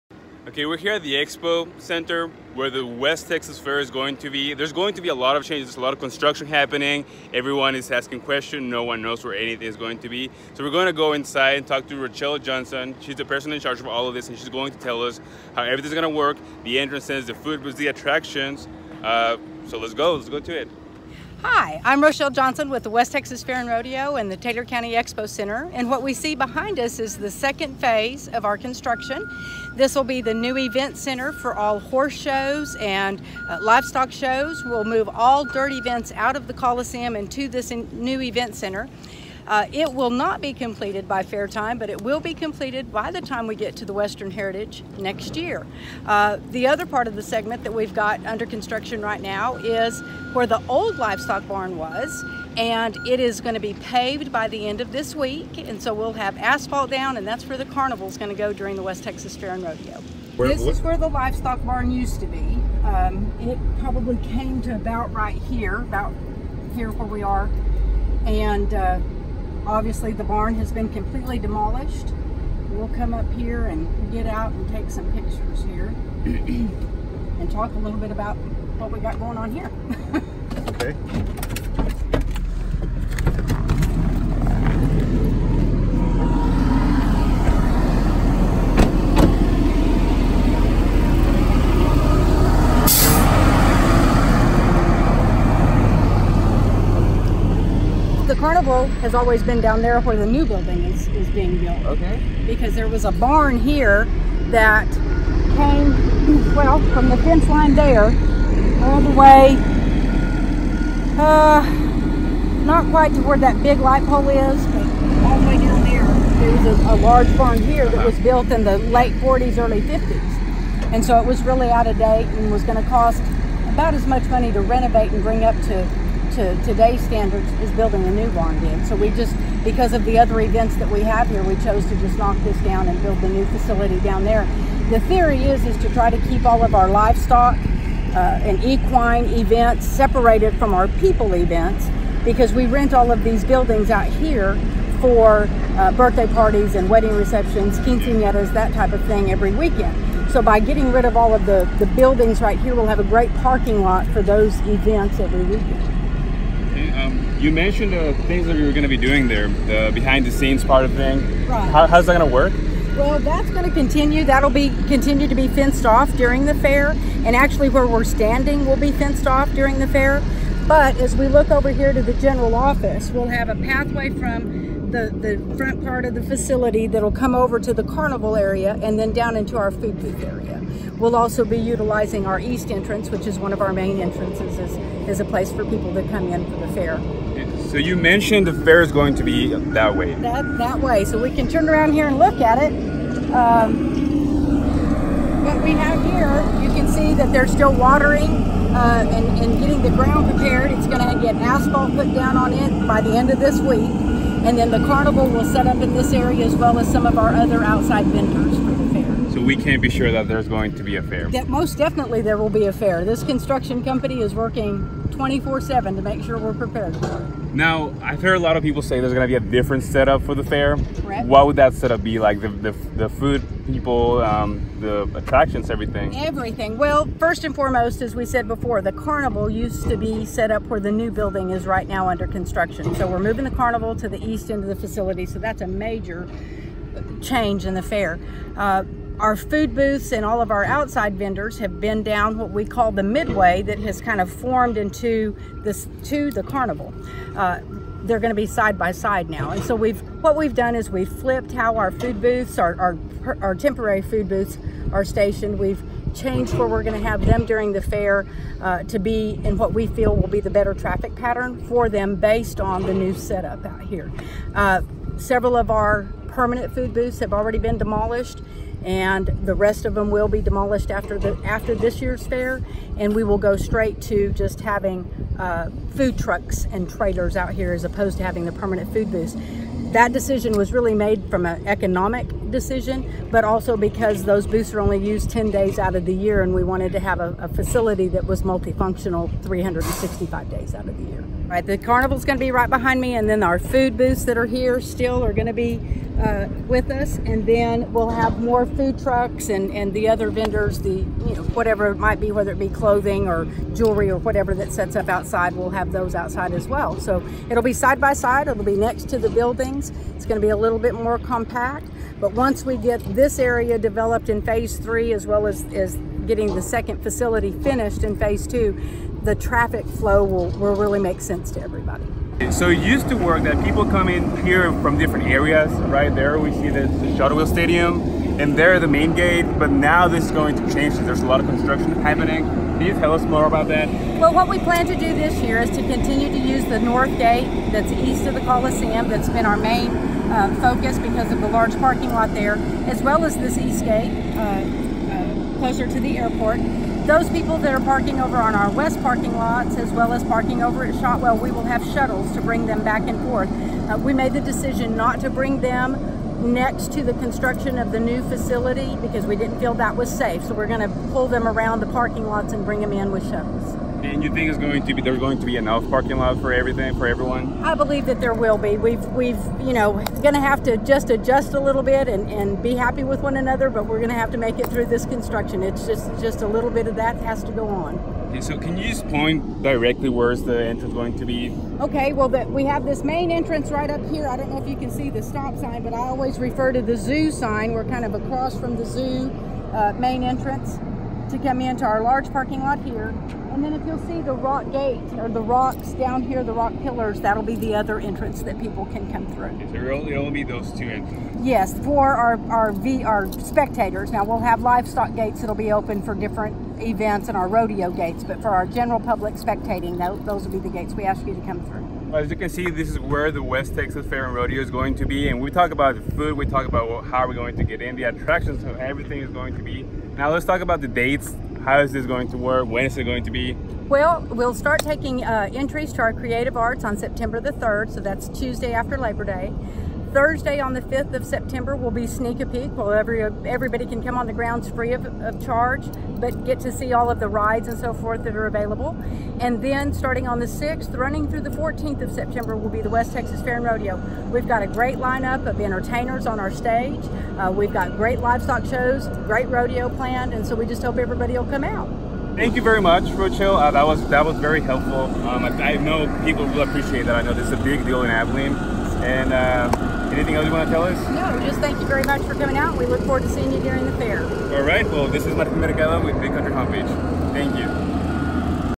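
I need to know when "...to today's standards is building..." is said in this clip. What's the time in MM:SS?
02:06.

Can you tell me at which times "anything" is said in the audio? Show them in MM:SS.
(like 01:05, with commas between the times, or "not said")
00:09, 07:40.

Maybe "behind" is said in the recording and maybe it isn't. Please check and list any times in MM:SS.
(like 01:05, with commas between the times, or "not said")
00:26, 02:39, 04:52.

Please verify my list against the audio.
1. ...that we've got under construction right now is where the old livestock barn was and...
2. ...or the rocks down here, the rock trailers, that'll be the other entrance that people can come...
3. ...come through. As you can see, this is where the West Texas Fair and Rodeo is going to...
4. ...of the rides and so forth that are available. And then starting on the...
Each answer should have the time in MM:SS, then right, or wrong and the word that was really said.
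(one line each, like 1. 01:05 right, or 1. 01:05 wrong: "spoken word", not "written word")
1. 00:47 right
2. 06:35 wrong: "pillars", not "trailers"
3. 06:51 right
4. 07:17 right.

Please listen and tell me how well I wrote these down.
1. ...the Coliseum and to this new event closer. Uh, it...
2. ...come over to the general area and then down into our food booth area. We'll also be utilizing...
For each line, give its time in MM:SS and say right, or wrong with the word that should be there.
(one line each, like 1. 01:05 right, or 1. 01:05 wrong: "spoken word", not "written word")
1. 00:36 wrong: "center", not "closer"
2. 02:57 wrong: "carnival", not "general".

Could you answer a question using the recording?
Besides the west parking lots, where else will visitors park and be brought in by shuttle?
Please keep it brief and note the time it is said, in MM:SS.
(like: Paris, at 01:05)
Shotwell, at 05:50.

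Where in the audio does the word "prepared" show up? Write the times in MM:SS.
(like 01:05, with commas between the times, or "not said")
03:20, 03:36.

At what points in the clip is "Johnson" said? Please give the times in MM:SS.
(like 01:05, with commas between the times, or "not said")
00:12, 00:22.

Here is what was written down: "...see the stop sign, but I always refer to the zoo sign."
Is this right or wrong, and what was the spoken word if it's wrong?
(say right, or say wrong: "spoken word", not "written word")
right.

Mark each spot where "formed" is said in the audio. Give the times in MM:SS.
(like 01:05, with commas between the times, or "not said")
04:04.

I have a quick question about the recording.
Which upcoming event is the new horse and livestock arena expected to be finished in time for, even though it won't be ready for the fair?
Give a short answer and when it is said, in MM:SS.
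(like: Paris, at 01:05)
Western Heritage, at 00:43.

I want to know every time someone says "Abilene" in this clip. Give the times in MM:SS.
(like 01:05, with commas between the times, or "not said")
07:38.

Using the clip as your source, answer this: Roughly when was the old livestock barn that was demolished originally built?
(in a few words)
late 40s, early 50s.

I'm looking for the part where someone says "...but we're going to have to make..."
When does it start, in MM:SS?
06:13.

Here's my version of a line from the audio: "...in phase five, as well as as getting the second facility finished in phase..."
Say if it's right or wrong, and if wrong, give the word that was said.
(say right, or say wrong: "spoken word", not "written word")
wrong: "three", not "five".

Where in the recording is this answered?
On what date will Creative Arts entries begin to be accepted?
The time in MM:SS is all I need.
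07:06.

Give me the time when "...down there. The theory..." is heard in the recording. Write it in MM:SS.
02:13.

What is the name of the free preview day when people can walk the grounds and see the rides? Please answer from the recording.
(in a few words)
sneak a peek.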